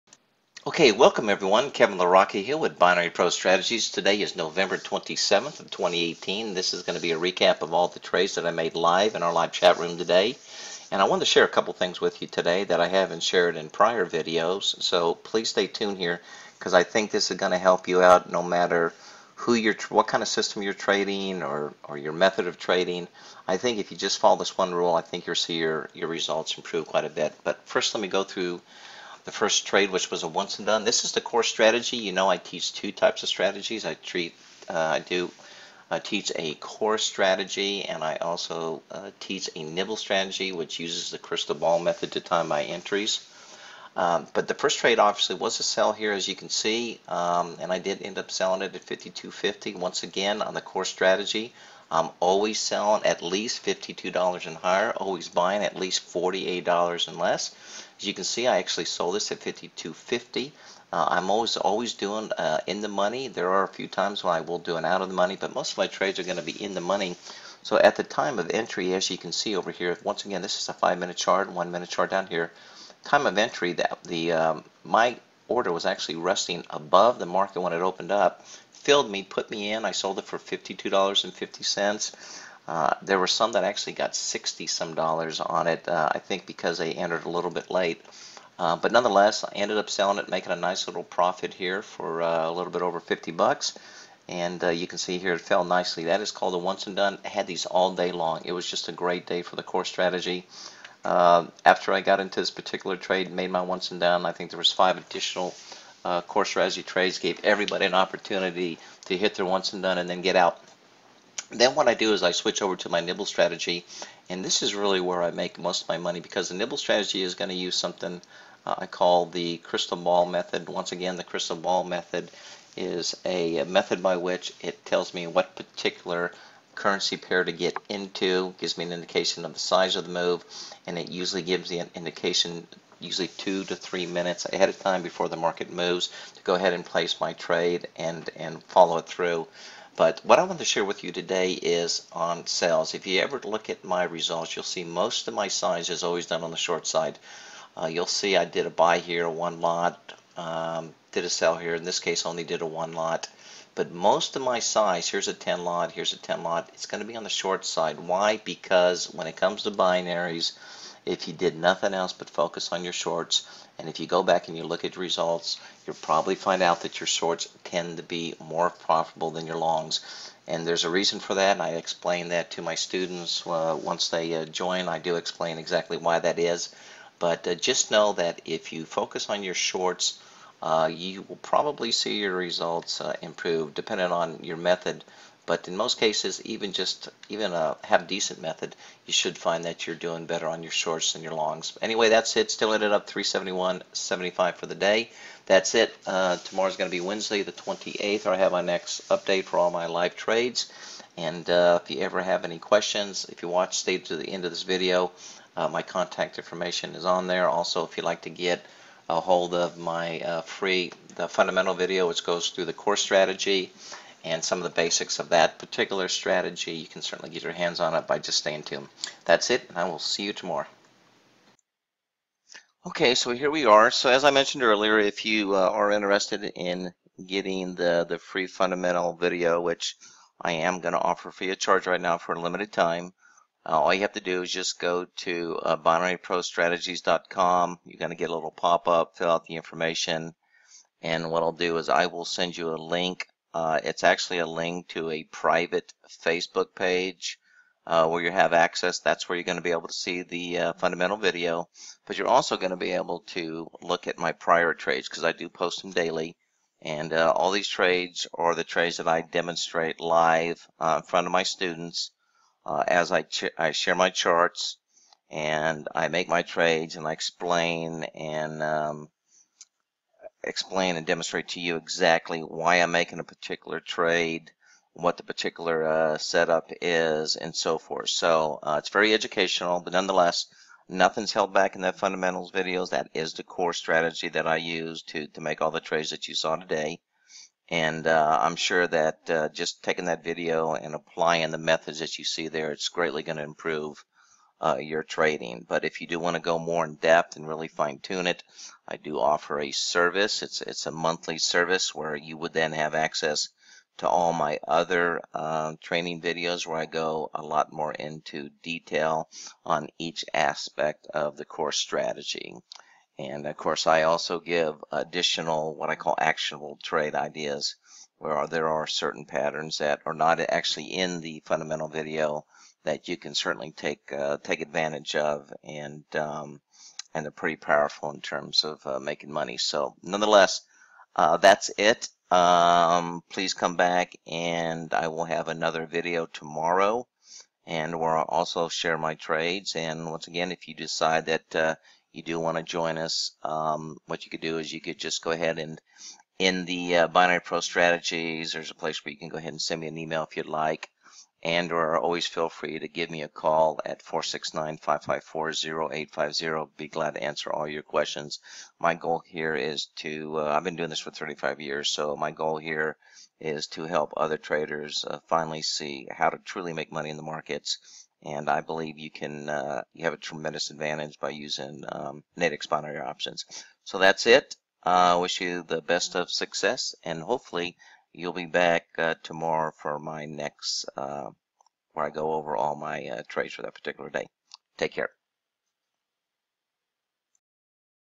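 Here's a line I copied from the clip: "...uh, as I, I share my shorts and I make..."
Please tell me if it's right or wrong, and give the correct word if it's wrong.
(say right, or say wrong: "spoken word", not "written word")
wrong: "charts", not "shorts".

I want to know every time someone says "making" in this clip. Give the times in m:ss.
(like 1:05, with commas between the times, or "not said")
1:30, 4:32, 5:28.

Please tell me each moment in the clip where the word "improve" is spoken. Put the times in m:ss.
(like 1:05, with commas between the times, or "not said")
0:26, 3:03, 4:53.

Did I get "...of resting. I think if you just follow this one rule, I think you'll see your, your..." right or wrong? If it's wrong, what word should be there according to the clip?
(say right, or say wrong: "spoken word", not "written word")
wrong: "trading", not "resting".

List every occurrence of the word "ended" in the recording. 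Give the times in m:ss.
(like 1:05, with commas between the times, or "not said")
1:29, 3:12.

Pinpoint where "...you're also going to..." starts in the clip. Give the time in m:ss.
4:12.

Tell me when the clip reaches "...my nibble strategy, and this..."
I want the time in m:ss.
1:52.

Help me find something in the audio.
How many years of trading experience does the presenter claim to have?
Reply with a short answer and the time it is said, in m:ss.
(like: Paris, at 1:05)
35, at 6:01.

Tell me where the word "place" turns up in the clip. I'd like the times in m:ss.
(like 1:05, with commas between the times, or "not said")
2:16, 5:48.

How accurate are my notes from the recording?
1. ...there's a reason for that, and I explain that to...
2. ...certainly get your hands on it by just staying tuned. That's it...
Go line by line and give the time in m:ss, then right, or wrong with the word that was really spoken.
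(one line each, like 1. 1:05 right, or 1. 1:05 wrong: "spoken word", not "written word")
1. 2:50 right
2. 3:37 right.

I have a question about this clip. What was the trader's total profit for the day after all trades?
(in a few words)
$371.75.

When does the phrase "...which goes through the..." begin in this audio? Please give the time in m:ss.
3:32.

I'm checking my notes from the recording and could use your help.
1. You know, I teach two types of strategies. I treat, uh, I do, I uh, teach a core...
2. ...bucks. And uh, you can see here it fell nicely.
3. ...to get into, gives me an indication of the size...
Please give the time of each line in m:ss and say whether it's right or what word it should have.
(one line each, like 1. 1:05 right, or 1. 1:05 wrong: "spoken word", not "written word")
1. 0:31 right
2. 1:33 right
3. 2:07 right.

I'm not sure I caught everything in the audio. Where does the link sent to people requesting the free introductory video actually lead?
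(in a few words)
private Facebook page.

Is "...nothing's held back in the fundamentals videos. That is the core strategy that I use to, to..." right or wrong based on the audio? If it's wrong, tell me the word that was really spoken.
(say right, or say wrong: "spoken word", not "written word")
right.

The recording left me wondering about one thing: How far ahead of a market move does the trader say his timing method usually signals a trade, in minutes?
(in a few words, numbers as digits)
2 to 3 minutes.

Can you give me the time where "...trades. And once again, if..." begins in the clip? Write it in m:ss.
5:39.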